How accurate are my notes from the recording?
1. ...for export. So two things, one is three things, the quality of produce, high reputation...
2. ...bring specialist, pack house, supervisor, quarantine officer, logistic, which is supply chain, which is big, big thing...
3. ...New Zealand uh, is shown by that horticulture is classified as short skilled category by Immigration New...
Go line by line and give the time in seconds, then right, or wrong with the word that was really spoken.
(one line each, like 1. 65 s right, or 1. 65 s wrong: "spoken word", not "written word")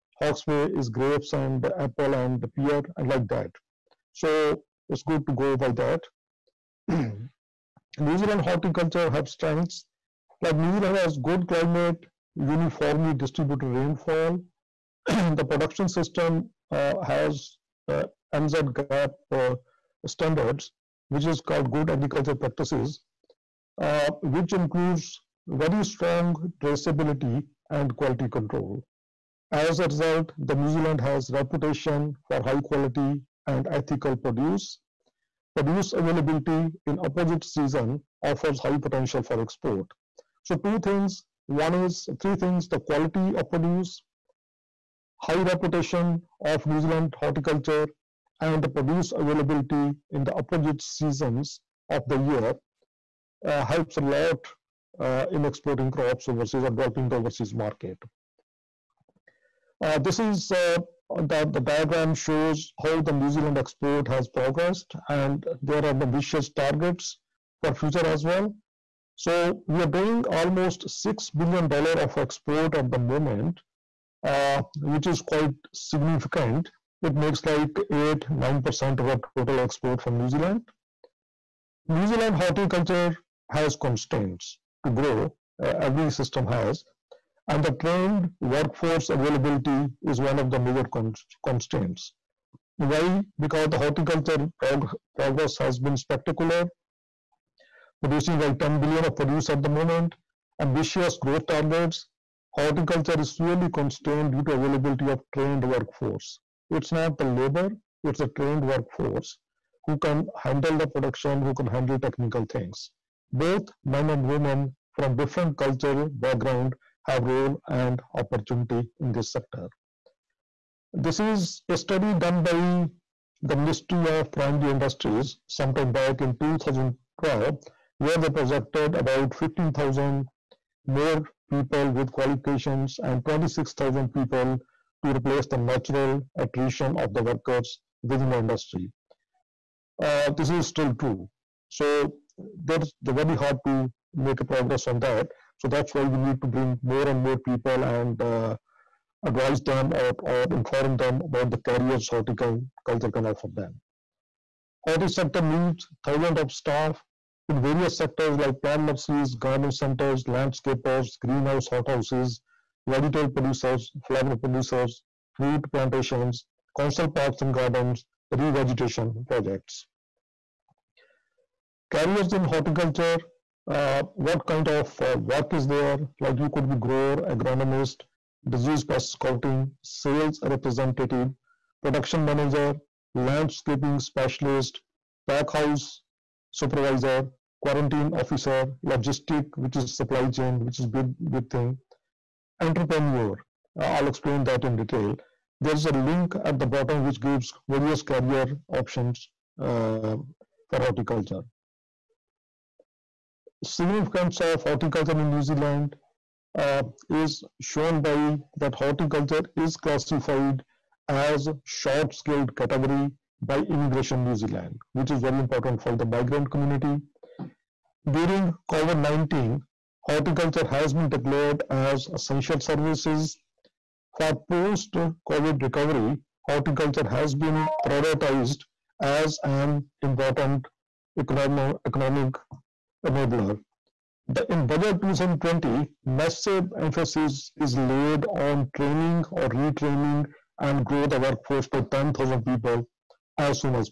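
1. 39 s right
2. 183 s wrong: "landscaping", not "bring"
3. 205 s right.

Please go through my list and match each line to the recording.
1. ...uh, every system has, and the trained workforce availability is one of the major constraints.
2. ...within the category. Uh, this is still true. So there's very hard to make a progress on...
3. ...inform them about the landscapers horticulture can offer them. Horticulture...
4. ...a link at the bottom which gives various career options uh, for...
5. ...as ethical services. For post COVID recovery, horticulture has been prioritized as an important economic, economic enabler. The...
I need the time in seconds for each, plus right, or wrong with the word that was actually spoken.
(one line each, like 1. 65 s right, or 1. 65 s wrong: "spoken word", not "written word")
1. 85 s right
2. 138 s wrong: "industry", not "category"
3. 150 s wrong: "careers", not "landscapers"
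4. 195 s right
5. 221 s wrong: "essential", not "ethical".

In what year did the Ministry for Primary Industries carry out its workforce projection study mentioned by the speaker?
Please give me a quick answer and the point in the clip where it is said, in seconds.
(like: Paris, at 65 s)
2012, at 126 s.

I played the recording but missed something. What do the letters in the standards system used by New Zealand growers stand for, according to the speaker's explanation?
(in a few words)
Good Agriculture Practices.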